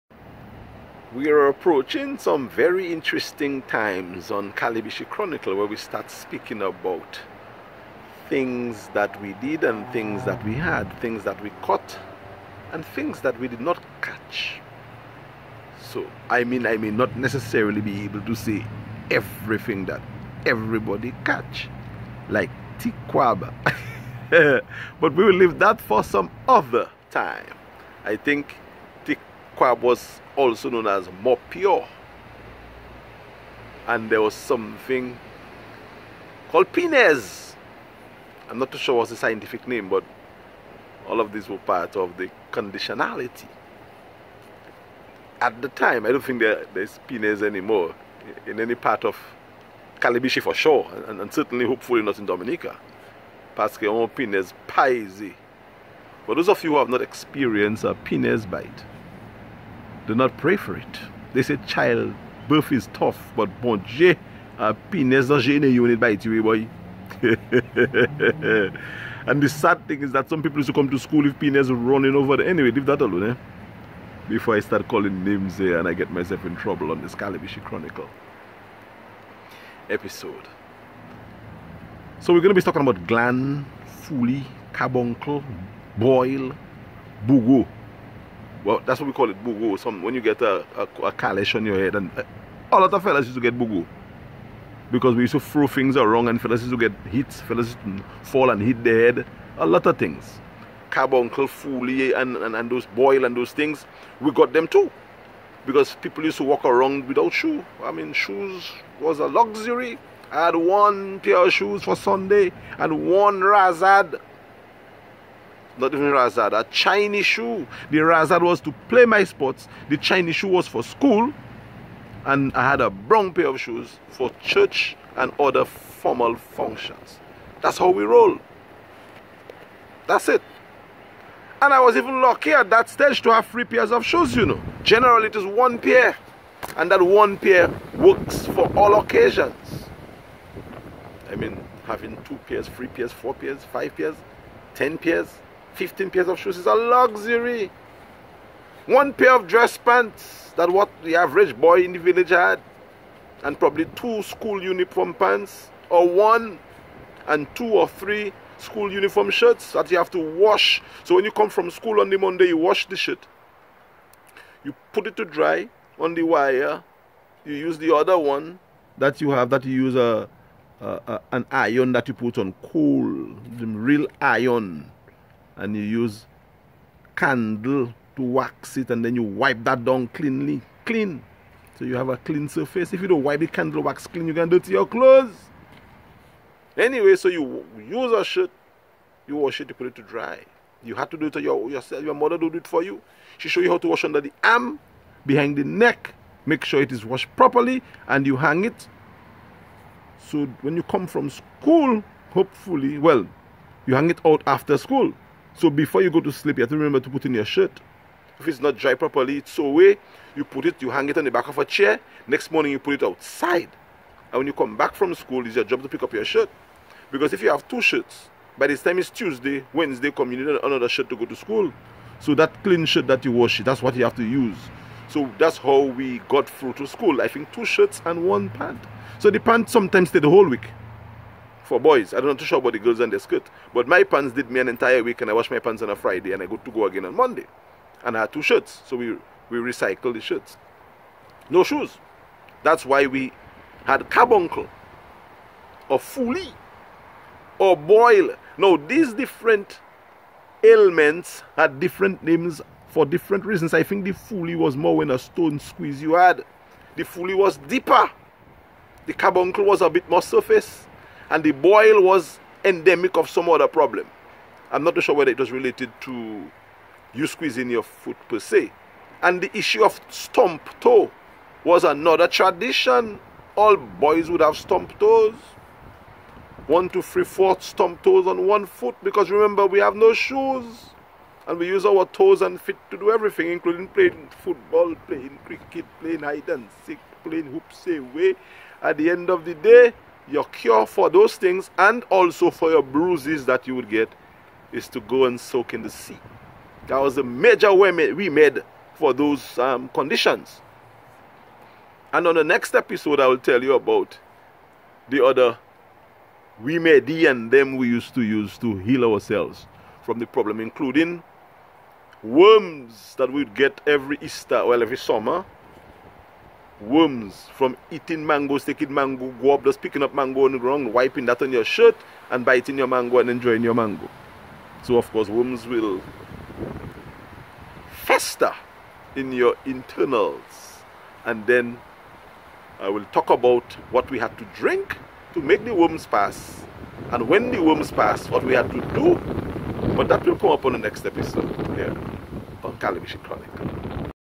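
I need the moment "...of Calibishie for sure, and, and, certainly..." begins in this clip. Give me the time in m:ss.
0:49.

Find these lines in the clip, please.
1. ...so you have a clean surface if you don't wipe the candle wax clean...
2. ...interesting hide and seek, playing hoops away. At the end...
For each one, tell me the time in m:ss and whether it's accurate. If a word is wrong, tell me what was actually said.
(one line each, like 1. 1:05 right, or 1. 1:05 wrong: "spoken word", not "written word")
1. 3:01 right
2. 4:46 wrong: "playing", not "interesting".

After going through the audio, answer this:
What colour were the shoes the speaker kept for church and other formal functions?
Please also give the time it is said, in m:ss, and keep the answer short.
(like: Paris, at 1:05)
Brown, at 2:02.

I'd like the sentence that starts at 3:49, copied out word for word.
So the pant sometimes stay the whole week for boys.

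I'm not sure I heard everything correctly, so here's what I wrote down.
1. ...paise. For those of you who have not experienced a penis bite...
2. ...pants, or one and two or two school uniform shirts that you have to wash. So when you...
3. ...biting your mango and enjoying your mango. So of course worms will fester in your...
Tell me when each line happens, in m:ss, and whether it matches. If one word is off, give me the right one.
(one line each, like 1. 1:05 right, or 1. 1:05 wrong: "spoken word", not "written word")
1. 0:54 right
2. 2:35 wrong: "three", not "two"
3. 5:22 right.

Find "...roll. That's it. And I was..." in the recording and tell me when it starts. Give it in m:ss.
2:08.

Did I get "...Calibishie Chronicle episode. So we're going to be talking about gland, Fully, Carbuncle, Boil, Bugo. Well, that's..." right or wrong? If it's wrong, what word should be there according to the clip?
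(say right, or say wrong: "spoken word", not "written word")
right.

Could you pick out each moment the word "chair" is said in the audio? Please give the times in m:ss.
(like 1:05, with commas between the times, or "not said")
3:31.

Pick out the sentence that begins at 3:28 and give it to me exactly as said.
If it's not dry properly, it's so away.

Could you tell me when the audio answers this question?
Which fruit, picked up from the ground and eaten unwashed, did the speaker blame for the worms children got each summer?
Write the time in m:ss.
5:18.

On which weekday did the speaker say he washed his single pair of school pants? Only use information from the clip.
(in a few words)
Friday.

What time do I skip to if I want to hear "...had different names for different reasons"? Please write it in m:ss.
4:11.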